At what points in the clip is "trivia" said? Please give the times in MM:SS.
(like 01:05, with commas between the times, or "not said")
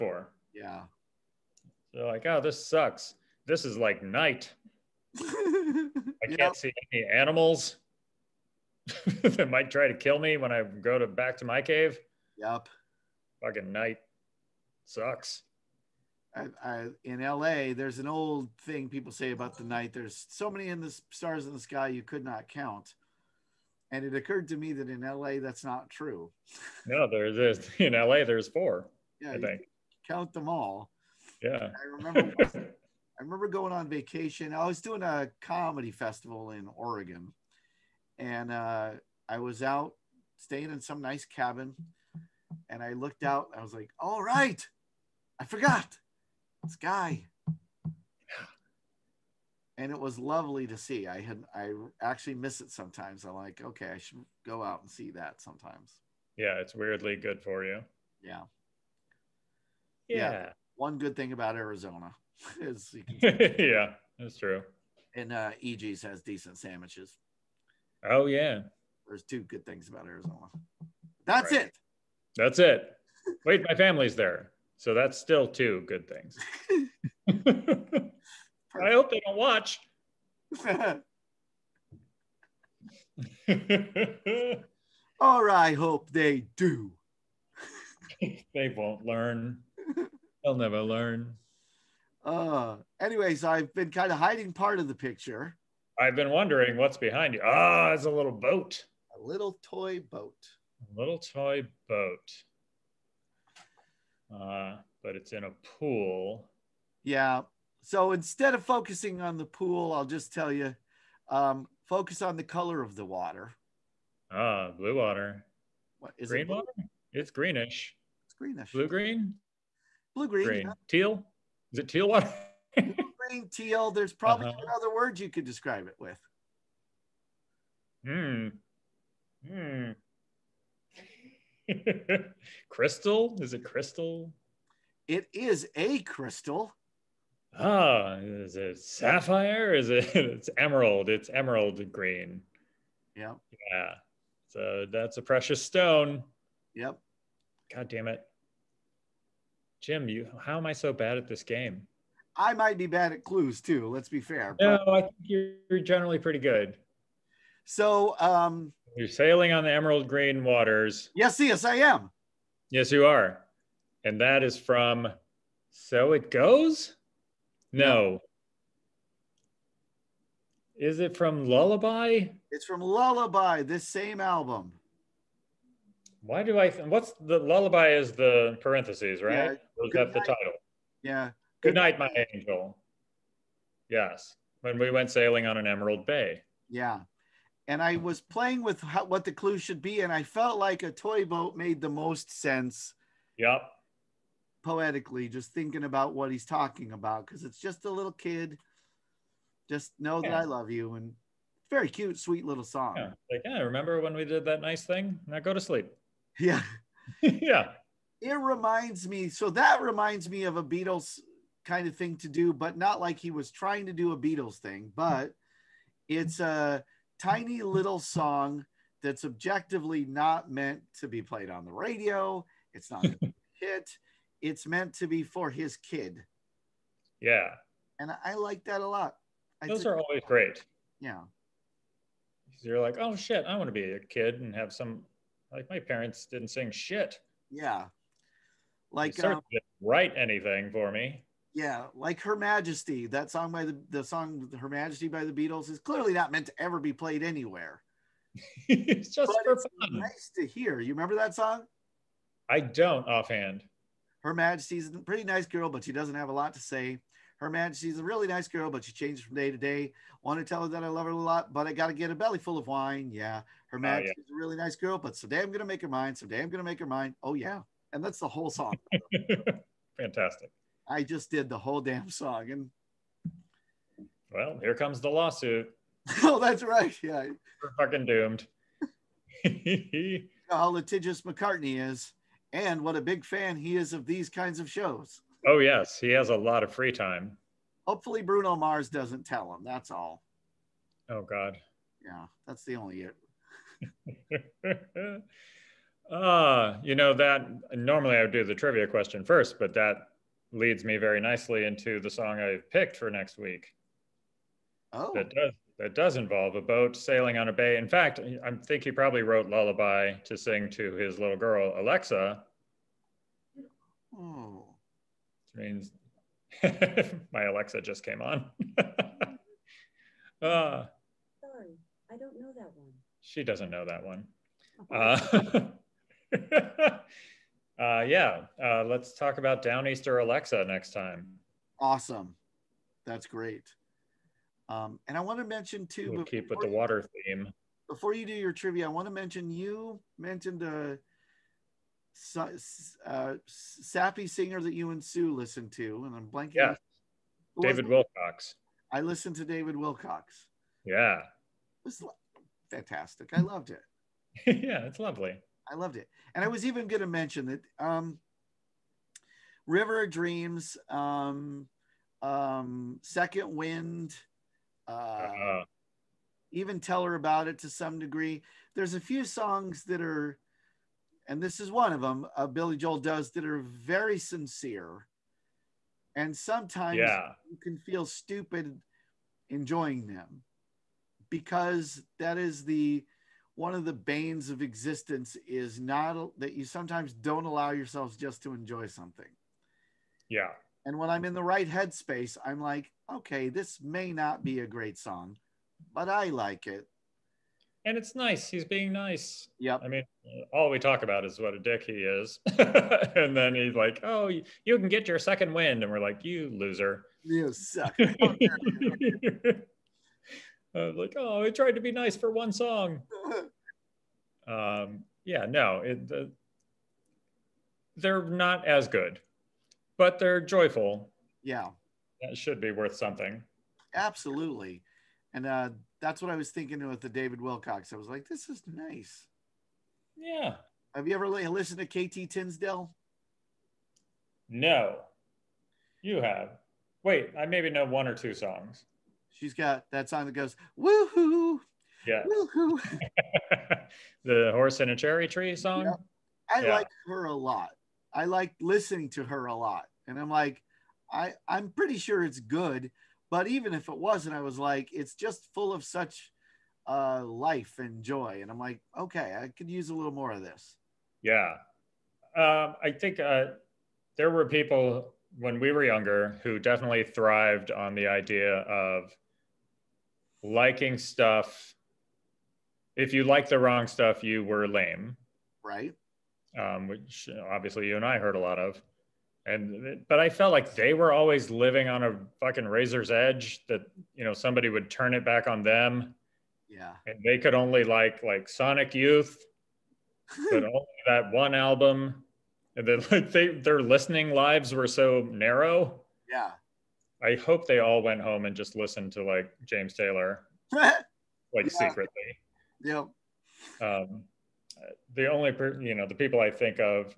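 04:58, 05:38.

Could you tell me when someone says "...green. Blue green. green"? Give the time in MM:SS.
01:58.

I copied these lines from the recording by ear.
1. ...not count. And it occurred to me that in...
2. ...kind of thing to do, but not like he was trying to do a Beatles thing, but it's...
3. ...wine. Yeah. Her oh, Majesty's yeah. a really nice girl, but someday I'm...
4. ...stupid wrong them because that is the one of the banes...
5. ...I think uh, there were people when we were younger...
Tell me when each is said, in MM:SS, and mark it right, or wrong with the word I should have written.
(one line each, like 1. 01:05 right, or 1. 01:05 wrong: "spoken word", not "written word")
1. 00:22 right
2. 03:31 right
3. 04:22 right
4. 06:18 wrong: "enjoying", not "wrong"
5. 07:42 right.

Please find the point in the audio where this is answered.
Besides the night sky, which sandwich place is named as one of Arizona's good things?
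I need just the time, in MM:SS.
01:05.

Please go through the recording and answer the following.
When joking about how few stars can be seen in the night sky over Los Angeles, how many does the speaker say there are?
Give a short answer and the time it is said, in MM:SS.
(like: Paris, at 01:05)
4, at 00:28.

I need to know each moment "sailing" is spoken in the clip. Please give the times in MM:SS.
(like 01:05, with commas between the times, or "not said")
02:39, 03:05, 05:06.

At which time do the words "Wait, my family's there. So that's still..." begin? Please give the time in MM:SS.
01:13.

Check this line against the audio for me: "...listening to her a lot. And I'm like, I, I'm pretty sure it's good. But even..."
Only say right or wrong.
right.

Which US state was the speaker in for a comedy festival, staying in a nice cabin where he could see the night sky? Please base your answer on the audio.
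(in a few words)
Oregon.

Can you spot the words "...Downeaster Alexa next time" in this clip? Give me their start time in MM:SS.
05:29.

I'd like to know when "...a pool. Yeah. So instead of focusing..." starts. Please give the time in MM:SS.
01:45.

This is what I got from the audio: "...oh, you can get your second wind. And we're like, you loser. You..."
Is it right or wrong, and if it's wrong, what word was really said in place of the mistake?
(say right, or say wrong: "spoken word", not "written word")
right.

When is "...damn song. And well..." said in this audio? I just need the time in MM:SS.
04:31.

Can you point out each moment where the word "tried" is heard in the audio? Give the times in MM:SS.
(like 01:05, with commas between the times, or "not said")
06:51.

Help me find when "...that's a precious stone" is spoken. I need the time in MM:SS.
02:24.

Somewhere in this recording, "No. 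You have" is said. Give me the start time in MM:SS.
07:14.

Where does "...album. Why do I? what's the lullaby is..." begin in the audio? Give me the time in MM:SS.
02:54.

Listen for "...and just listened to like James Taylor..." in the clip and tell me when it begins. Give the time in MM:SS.
08:18.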